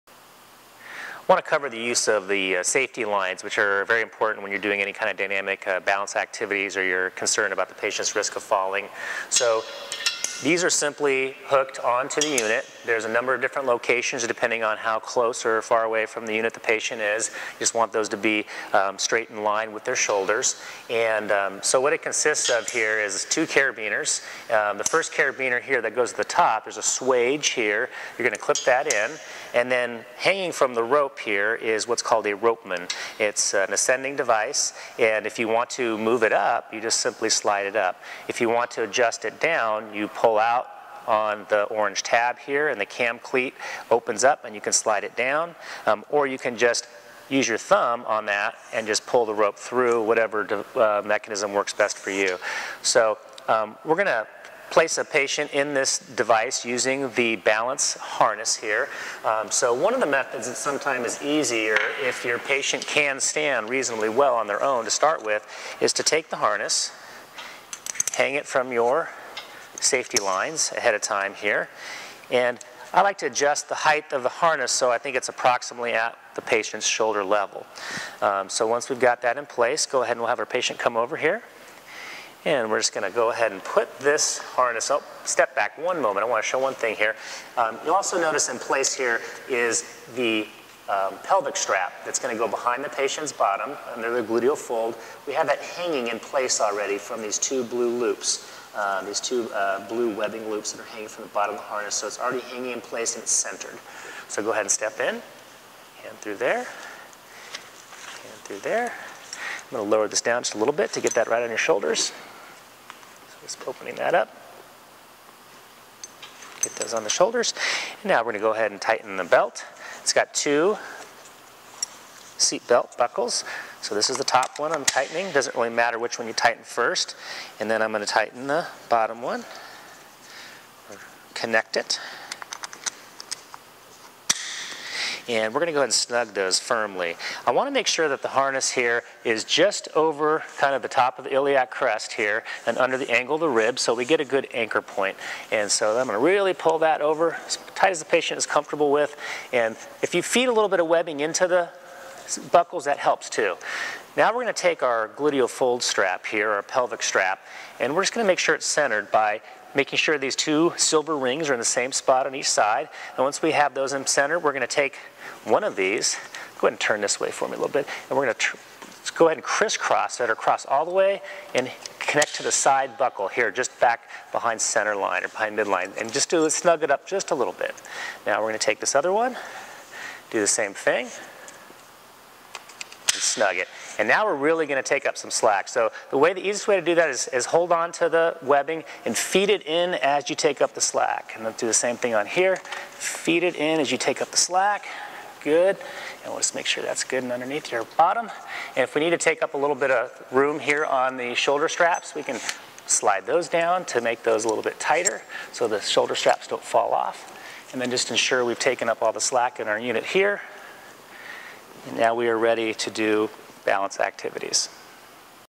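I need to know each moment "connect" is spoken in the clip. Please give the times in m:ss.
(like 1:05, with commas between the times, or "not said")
2:11, 2:51.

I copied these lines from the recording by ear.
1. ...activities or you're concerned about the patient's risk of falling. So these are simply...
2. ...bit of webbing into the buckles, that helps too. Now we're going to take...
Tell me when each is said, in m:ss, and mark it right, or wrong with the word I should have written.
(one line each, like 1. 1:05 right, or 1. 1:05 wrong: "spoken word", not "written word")
1. 0:06 right
2. 2:30 right.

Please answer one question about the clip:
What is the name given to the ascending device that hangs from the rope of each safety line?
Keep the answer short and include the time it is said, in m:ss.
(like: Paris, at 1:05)
ropeman, at 0:32.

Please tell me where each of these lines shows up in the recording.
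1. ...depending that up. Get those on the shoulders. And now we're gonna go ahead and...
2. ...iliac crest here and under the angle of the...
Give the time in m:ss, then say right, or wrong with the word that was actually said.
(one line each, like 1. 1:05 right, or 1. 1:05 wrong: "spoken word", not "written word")
1. 1:53 wrong: "opening", not "depending"
2. 2:21 right.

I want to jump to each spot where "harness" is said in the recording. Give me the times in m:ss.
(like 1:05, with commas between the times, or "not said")
0:57, 1:06, 1:14, 1:24, 1:41, 2:18.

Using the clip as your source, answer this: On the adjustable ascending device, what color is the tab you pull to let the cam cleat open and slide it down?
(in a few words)
orange.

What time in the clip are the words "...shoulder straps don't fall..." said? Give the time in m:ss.
3:25.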